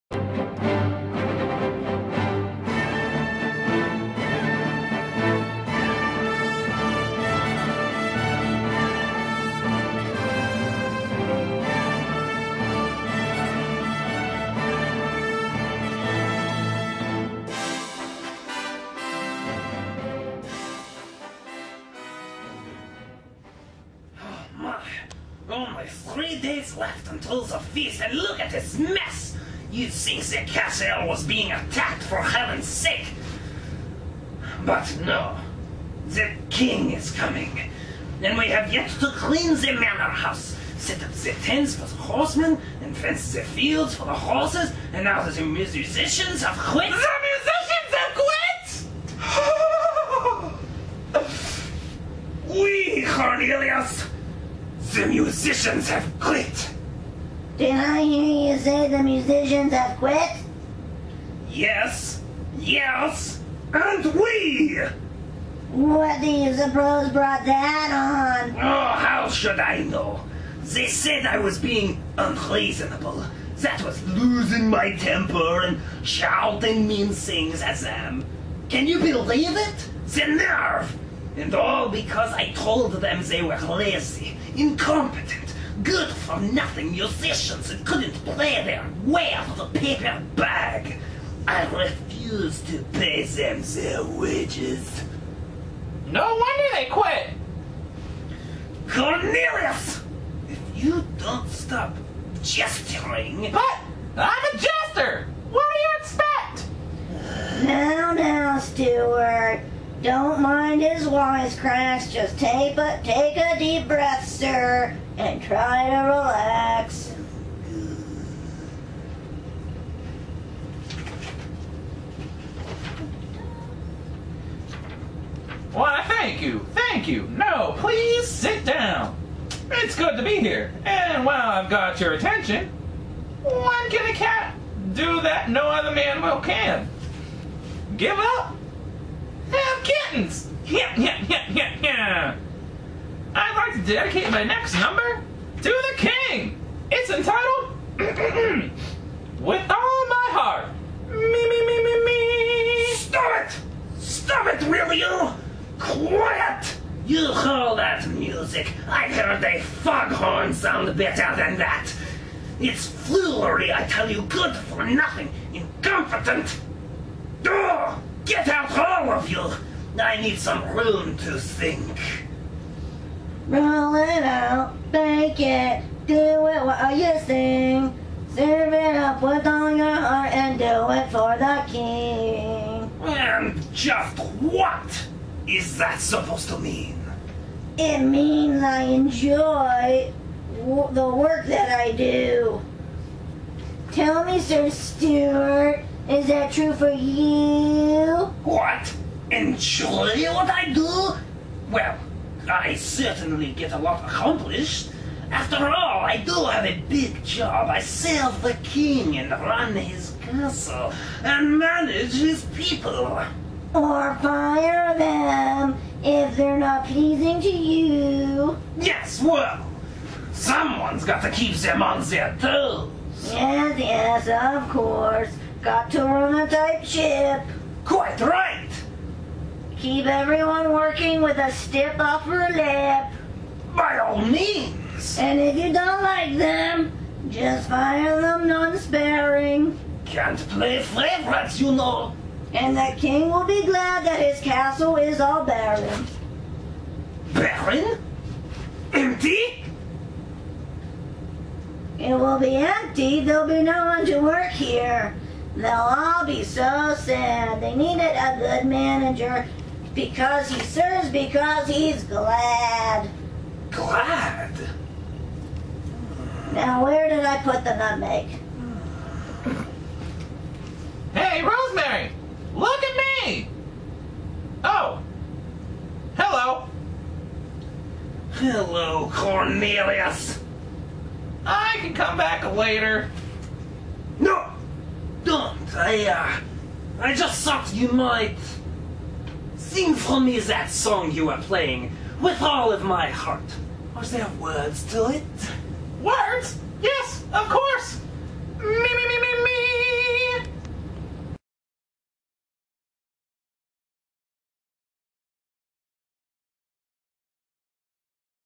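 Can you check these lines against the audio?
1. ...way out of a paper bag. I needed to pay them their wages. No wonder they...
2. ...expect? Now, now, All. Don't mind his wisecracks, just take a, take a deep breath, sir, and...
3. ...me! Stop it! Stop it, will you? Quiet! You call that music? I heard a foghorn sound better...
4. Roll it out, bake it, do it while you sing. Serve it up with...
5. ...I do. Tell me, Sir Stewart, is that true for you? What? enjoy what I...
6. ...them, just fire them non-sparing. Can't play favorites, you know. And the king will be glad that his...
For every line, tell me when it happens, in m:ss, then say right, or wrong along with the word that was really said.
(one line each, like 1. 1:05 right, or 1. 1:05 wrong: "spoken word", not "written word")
1. 1:29 wrong: "refused", not "needed"
2. 1:46 wrong: "Stuart", not "All"
3. 2:32 right
4. 2:53 right
5. 3:11 right
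6. 3:56 right.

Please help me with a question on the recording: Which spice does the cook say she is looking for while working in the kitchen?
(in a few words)
Nutmeg.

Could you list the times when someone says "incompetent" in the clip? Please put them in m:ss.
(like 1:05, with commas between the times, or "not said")
1:24, 2:45.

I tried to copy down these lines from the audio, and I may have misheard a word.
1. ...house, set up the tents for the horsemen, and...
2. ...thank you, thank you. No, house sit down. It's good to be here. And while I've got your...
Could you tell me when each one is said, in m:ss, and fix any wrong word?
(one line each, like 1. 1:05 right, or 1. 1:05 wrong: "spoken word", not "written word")
1. 0:40 right
2. 2:06 wrong: "please", not "house".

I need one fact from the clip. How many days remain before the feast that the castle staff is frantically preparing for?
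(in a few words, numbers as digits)
3.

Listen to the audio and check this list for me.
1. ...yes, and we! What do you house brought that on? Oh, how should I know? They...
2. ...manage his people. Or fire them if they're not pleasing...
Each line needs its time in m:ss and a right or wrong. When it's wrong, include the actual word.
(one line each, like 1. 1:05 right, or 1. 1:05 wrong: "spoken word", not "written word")
1. 1:02 wrong: "suppose", not "house"
2. 3:31 right.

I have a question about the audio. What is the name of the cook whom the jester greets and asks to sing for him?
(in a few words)
Rosemary.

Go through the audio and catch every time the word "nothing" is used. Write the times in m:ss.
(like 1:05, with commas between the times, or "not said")
1:26, 2:44.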